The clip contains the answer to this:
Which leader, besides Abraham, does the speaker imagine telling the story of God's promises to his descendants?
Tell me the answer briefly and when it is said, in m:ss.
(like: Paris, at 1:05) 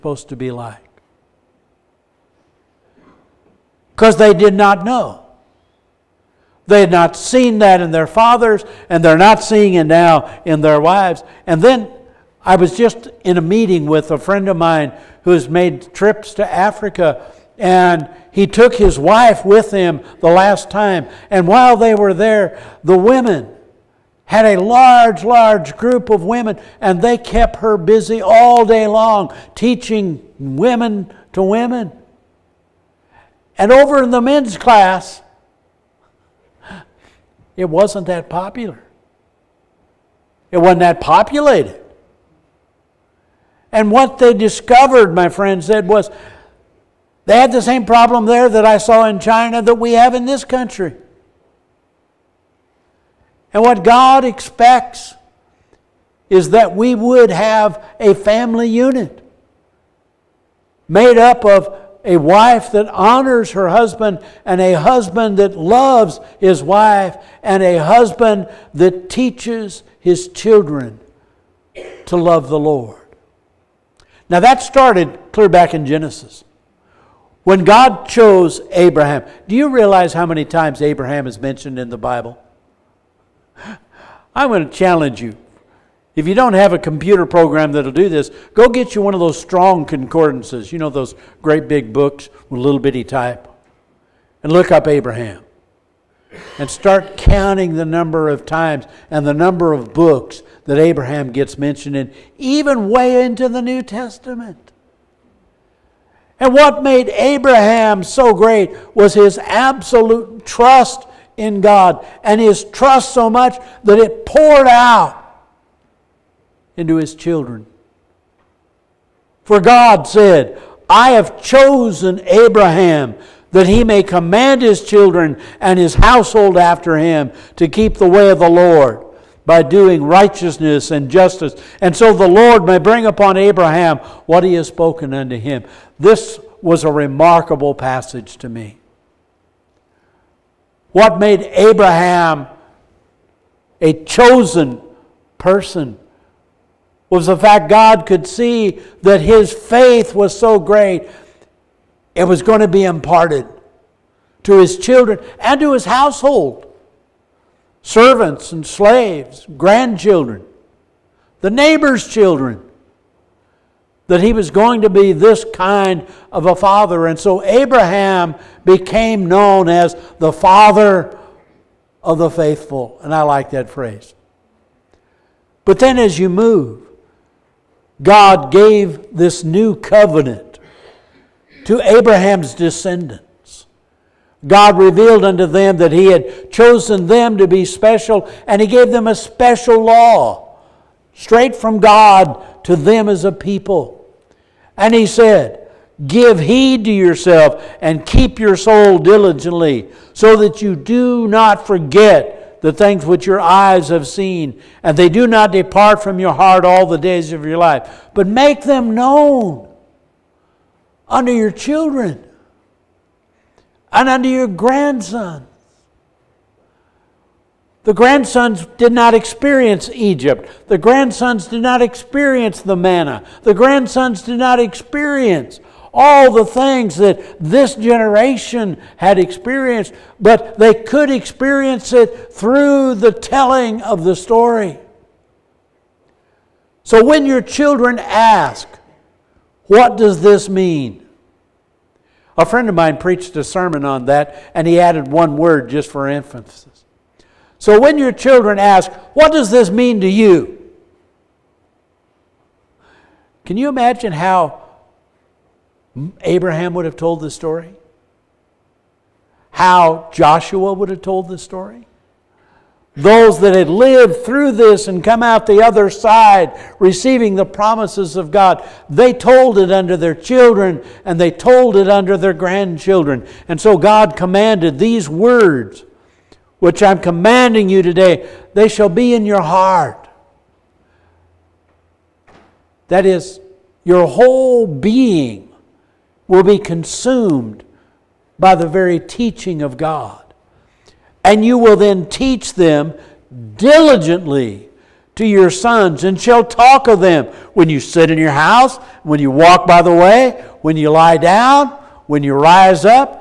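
Joshua, at 4:20.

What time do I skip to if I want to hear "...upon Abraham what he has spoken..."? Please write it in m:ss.
2:13.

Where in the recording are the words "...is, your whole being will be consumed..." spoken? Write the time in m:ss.
4:43.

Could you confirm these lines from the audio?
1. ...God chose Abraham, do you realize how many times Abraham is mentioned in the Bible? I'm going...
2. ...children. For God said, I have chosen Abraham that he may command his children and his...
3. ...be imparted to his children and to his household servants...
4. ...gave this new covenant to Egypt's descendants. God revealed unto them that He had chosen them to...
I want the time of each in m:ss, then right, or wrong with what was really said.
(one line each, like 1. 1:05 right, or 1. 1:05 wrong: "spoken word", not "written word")
1. 1:17 right
2. 1:57 right
3. 2:32 right
4. 2:58 wrong: "Abraham", not "Egypt".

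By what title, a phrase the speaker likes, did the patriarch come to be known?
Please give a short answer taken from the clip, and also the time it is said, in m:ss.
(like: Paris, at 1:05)
Father of the faithful, at 2:50.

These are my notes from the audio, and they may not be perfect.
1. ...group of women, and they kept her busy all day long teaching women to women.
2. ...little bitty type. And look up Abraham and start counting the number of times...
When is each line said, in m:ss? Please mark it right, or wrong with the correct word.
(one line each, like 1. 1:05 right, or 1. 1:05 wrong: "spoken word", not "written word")
1. 0:25 right
2. 1:32 right.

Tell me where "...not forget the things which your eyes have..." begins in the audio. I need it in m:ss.
3:21.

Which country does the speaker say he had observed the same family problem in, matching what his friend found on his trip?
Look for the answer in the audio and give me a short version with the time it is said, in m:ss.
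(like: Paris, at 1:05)
China, at 0:49.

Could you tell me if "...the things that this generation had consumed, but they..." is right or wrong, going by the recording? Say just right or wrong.
wrong.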